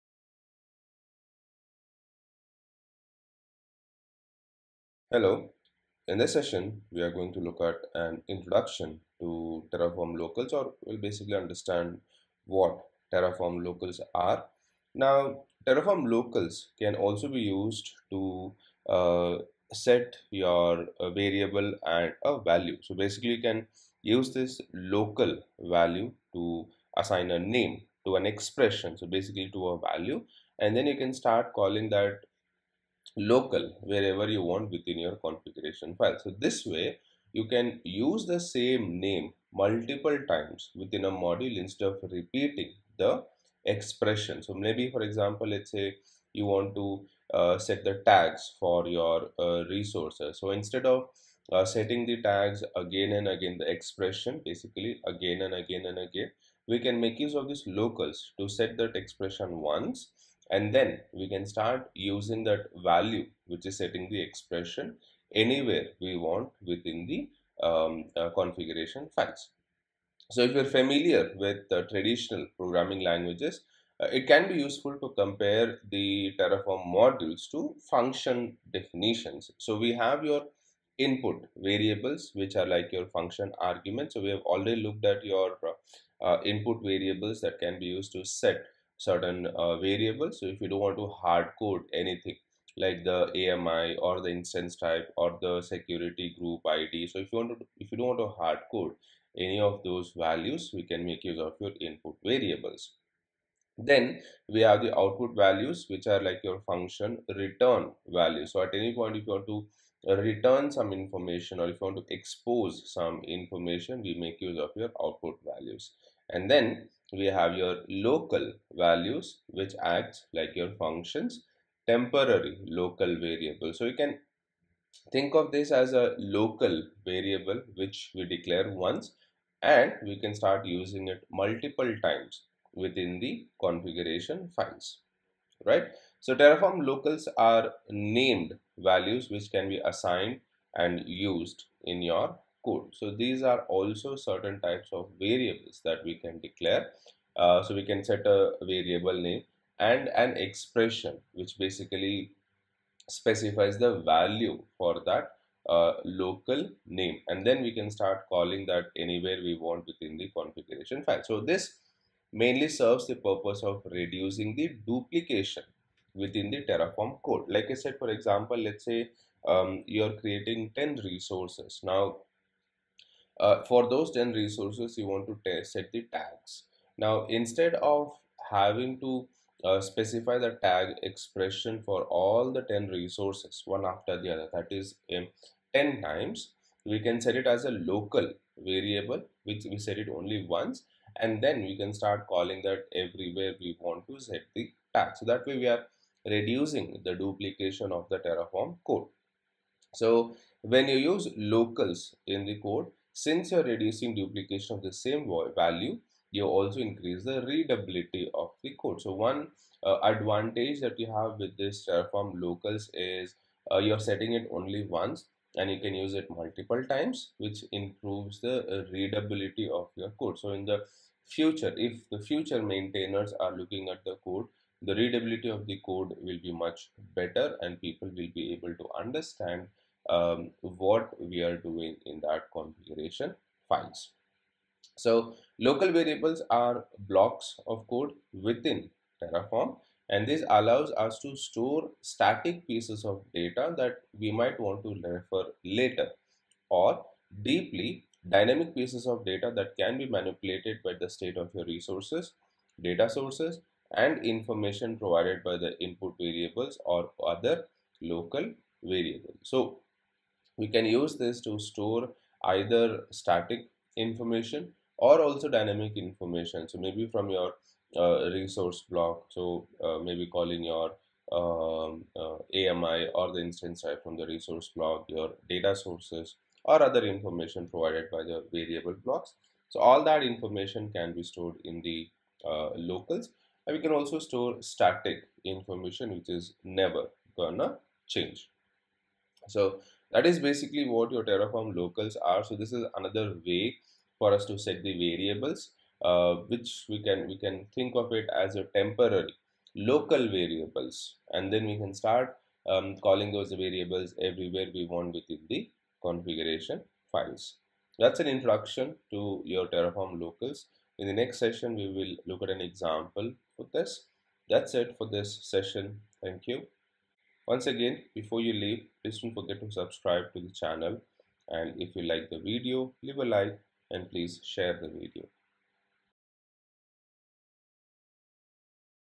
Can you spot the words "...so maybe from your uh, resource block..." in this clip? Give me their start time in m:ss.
4:26.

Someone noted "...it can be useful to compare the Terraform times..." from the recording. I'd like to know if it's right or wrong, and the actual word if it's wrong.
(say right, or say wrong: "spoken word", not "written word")
wrong: "modules", not "times".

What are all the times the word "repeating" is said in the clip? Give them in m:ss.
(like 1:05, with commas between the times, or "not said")
0:42.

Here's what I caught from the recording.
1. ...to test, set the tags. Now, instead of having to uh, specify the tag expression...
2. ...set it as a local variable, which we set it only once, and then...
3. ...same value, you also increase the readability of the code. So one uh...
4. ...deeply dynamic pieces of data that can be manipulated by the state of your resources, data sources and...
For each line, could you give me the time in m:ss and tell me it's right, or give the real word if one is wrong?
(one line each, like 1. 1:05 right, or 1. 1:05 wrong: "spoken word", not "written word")
1. 2:55 right
2. 3:07 right
3. 3:24 right
4. 4:07 right.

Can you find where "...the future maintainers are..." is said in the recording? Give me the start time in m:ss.
3:42.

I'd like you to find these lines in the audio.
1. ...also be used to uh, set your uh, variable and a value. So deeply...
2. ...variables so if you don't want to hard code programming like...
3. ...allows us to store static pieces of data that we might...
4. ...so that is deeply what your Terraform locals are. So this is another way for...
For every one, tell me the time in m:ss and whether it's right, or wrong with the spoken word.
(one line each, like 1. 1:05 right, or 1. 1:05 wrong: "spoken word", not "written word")
1. 0:16 wrong: "basically", not "deeply"
2. 1:29 wrong: "anything", not "programming"
3. 4:00 right
4. 4:49 wrong: "basically", not "deeply".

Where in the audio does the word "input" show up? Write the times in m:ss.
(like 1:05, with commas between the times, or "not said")
1:20, 1:26, 1:41, 4:15.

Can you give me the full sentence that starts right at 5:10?
In the next session, we will look at an example for this.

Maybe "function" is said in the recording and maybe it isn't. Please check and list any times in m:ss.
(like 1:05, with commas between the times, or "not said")
1:17, 1:23, 1:46, 2:00.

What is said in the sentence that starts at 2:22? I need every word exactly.
So these are also certain types of variables that we can declare.